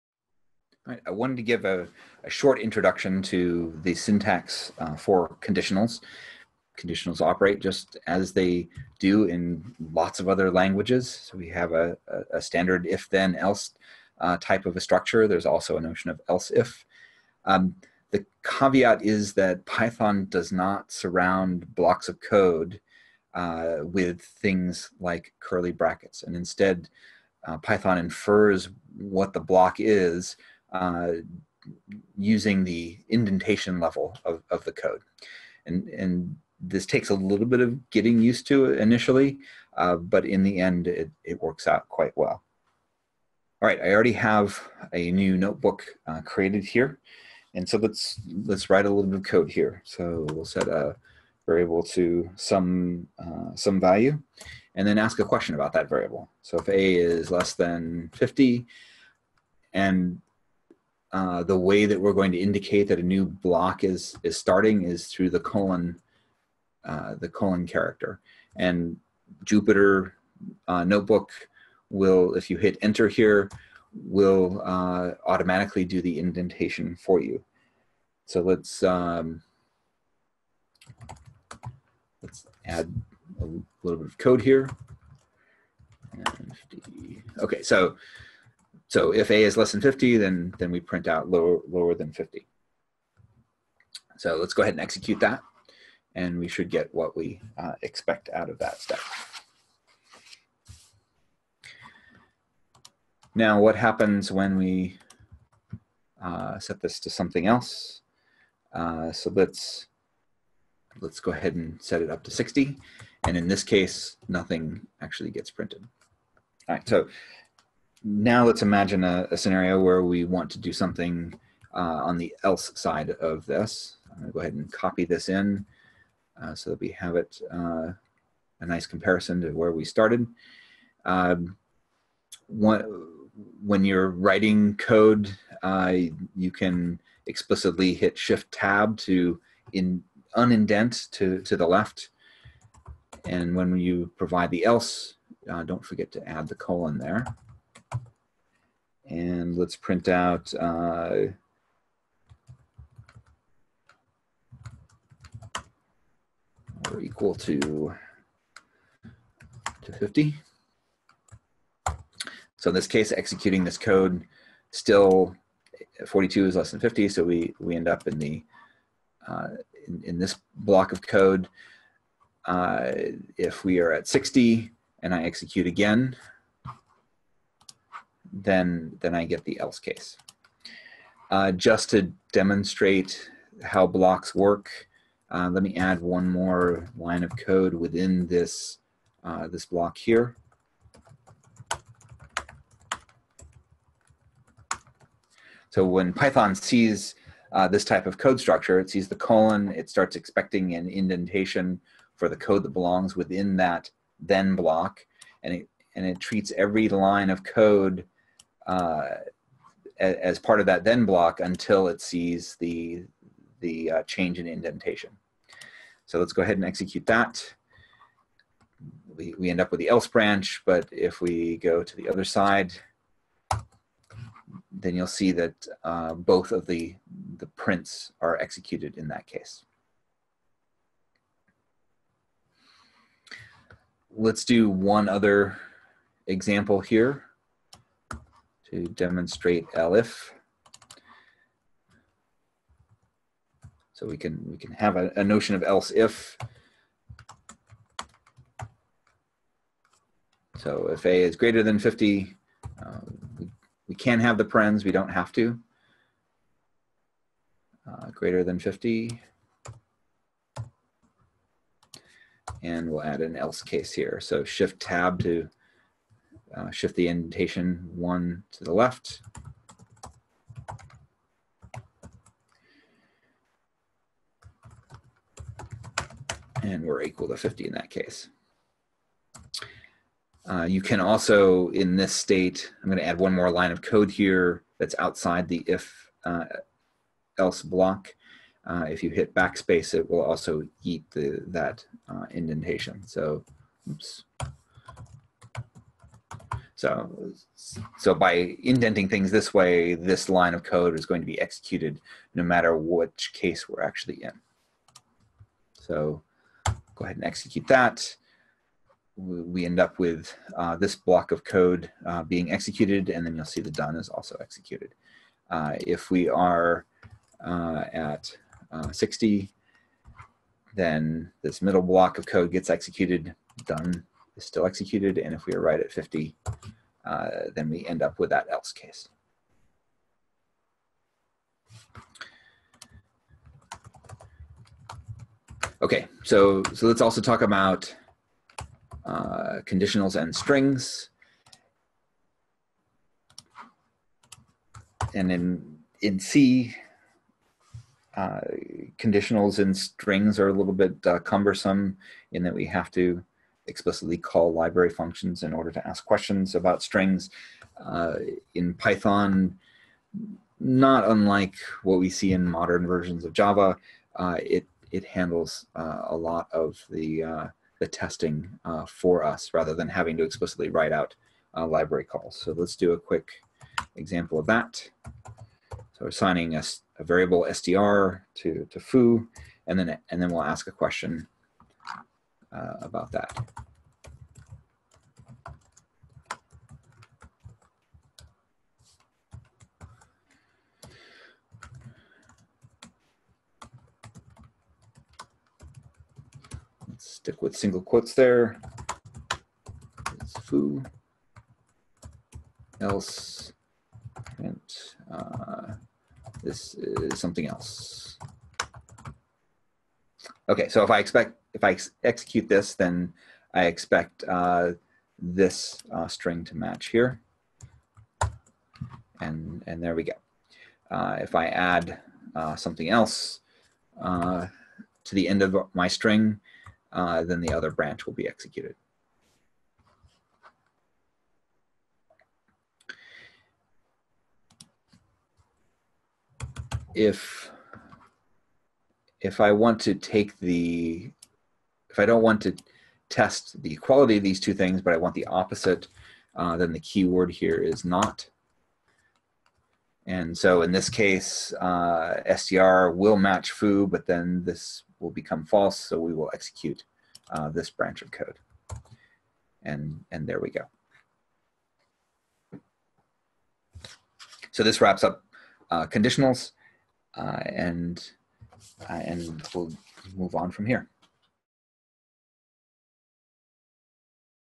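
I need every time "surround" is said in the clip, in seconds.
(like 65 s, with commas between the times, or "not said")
20 s.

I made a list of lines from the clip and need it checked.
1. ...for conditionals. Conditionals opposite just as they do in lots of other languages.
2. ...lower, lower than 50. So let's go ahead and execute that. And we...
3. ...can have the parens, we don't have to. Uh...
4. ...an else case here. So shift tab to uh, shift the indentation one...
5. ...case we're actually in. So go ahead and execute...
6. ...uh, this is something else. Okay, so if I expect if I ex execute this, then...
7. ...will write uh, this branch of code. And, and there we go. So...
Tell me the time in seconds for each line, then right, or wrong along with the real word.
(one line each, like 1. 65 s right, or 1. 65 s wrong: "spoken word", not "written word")
1. 4 s wrong: "operate", not "opposite"
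2. 91 s right
3. 253 s right
4. 263 s right
5. 303 s right
6. 405 s right
7. 456 s wrong: "execute", not "write".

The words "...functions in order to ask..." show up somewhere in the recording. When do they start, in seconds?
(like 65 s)
354 s.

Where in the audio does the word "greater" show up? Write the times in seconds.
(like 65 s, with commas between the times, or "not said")
251 s, 258 s.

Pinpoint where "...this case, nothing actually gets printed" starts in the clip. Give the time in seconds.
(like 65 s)
113 s.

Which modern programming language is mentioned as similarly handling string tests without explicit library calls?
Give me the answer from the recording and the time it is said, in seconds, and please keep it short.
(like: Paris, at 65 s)
Java, at 363 s.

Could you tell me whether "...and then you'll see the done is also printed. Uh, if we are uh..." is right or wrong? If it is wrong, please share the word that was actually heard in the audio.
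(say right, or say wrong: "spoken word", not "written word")
wrong: "executed", not "printed".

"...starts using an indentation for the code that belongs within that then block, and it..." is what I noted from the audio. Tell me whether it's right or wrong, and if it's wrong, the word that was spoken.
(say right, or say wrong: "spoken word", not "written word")
wrong: "expecting", not "using".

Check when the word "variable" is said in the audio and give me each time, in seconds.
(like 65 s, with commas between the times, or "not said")
51 s, 55 s, 377 s.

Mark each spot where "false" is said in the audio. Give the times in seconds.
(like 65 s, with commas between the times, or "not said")
455 s.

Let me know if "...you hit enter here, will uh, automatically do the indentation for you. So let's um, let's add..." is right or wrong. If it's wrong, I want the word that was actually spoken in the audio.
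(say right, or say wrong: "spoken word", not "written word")
right.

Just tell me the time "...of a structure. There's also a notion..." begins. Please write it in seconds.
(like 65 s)
14 s.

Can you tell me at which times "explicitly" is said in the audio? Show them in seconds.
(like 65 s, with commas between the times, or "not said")
137 s, 353 s, 370 s.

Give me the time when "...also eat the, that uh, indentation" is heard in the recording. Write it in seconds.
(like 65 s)
290 s.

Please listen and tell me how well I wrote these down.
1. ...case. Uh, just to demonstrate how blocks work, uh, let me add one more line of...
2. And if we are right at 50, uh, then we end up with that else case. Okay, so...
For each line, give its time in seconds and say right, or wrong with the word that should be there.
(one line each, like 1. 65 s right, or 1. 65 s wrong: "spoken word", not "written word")
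1. 179 s right
2. 325 s right.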